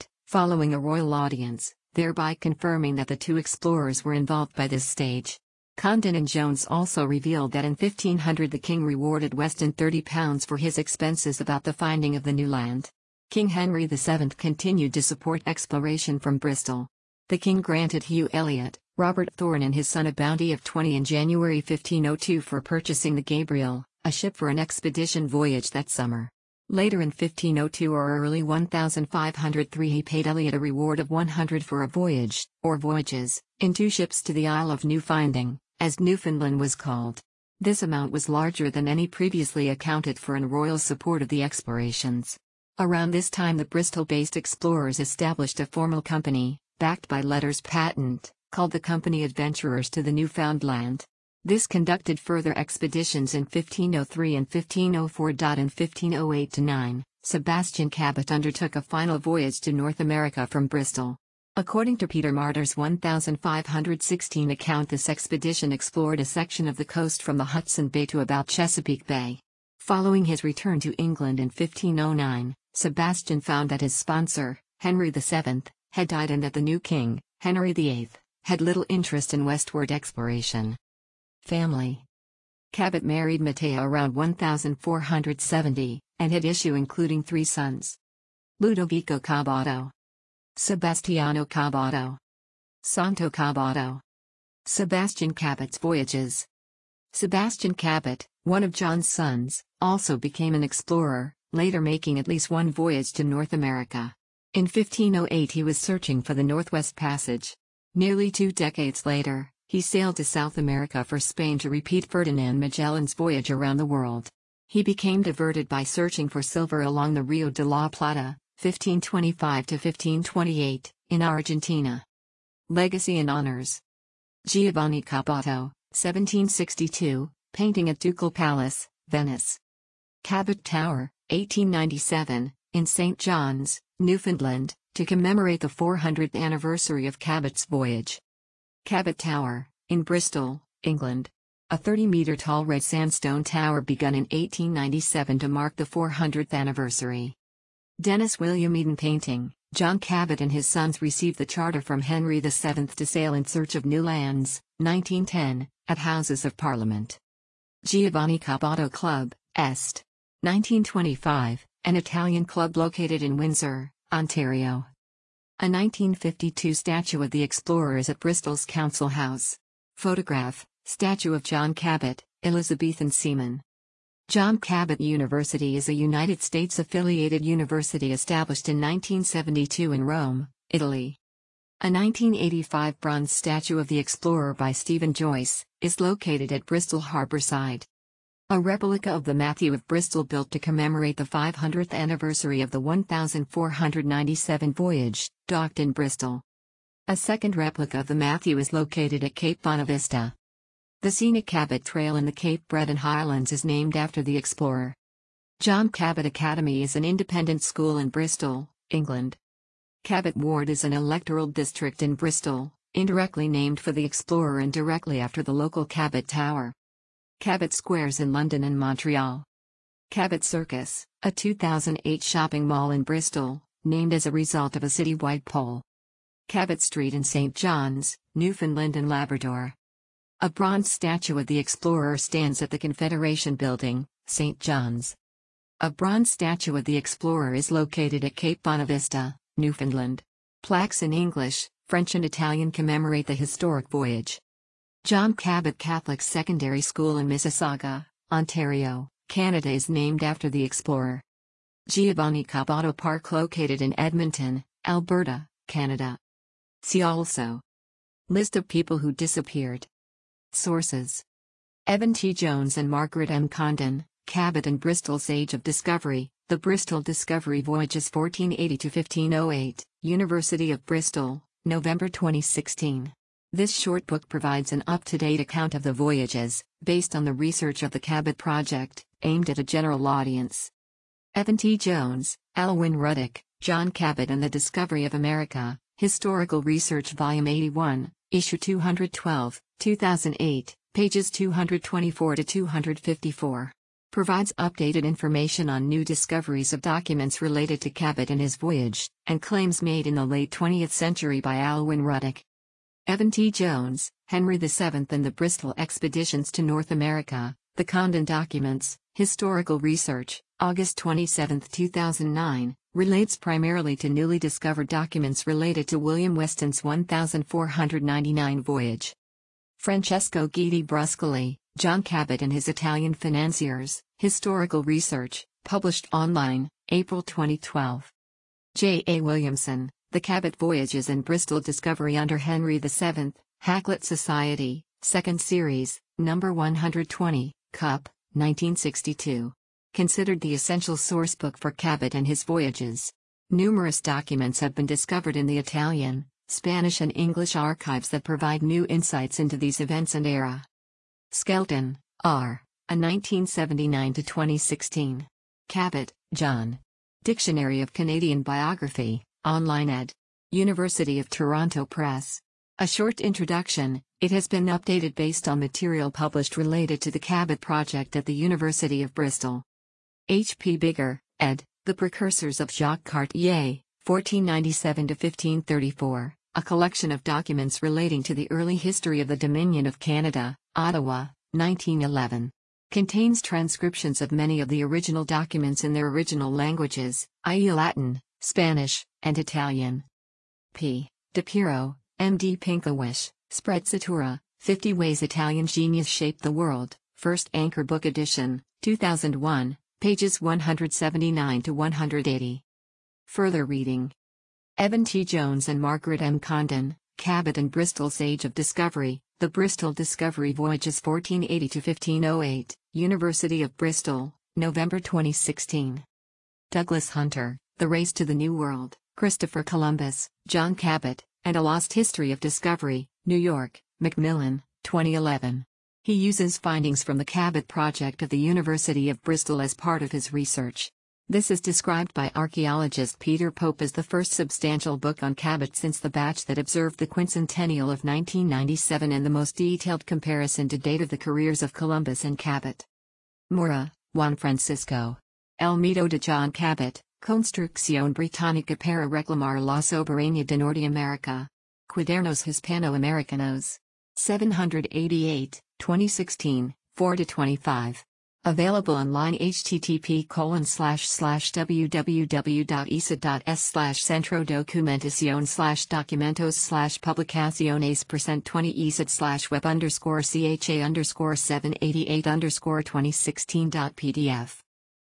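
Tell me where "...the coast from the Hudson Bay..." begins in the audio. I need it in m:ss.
1:06.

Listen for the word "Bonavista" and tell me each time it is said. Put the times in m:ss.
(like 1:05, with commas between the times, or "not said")
3:19, 3:58.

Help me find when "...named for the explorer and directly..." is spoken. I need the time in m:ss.
3:33.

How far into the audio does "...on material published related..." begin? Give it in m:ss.
6:05.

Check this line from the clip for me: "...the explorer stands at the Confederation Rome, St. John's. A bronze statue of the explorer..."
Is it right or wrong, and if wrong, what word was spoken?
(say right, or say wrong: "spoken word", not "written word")
wrong: "Building", not "Rome".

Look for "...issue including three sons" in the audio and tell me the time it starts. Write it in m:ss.
1:26.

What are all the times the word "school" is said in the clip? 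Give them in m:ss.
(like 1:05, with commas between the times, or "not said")
3:27, 4:06.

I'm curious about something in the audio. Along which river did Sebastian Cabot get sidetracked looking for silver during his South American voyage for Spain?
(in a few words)
Rio de la Plata.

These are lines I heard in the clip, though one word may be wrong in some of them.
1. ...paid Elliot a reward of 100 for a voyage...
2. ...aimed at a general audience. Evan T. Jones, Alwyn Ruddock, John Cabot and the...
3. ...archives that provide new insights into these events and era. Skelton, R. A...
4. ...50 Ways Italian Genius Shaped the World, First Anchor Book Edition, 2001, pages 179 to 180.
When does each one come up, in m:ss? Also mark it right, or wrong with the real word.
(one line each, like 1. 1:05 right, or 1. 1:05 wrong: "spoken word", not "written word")
1. 0:30 right
2. 4:39 right
3. 5:47 right
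4. 6:34 right.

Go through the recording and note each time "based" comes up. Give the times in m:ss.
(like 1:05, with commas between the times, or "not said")
0:43, 4:36, 6:05.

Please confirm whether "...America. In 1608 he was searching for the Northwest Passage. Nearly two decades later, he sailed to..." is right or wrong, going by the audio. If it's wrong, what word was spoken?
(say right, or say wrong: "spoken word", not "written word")
wrong: "1508", not "1608".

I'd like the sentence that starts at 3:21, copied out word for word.
The scenic Cabot Trail in the Cape Breton Highlands is named after the explorer.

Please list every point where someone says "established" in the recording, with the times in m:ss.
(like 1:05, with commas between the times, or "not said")
0:44, 2:58.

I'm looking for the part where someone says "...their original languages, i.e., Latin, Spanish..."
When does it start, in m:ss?
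6:25.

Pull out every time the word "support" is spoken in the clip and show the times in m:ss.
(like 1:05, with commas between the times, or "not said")
0:15, 0:40.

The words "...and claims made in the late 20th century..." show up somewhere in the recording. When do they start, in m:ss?
4:59.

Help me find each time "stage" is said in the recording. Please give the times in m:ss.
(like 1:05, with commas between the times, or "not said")
0:04.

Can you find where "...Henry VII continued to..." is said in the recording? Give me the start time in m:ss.
0:13.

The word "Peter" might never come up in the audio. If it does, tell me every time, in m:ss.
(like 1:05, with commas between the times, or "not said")
1:02, 7:13.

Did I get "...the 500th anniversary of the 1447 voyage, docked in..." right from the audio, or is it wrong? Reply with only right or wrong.
wrong.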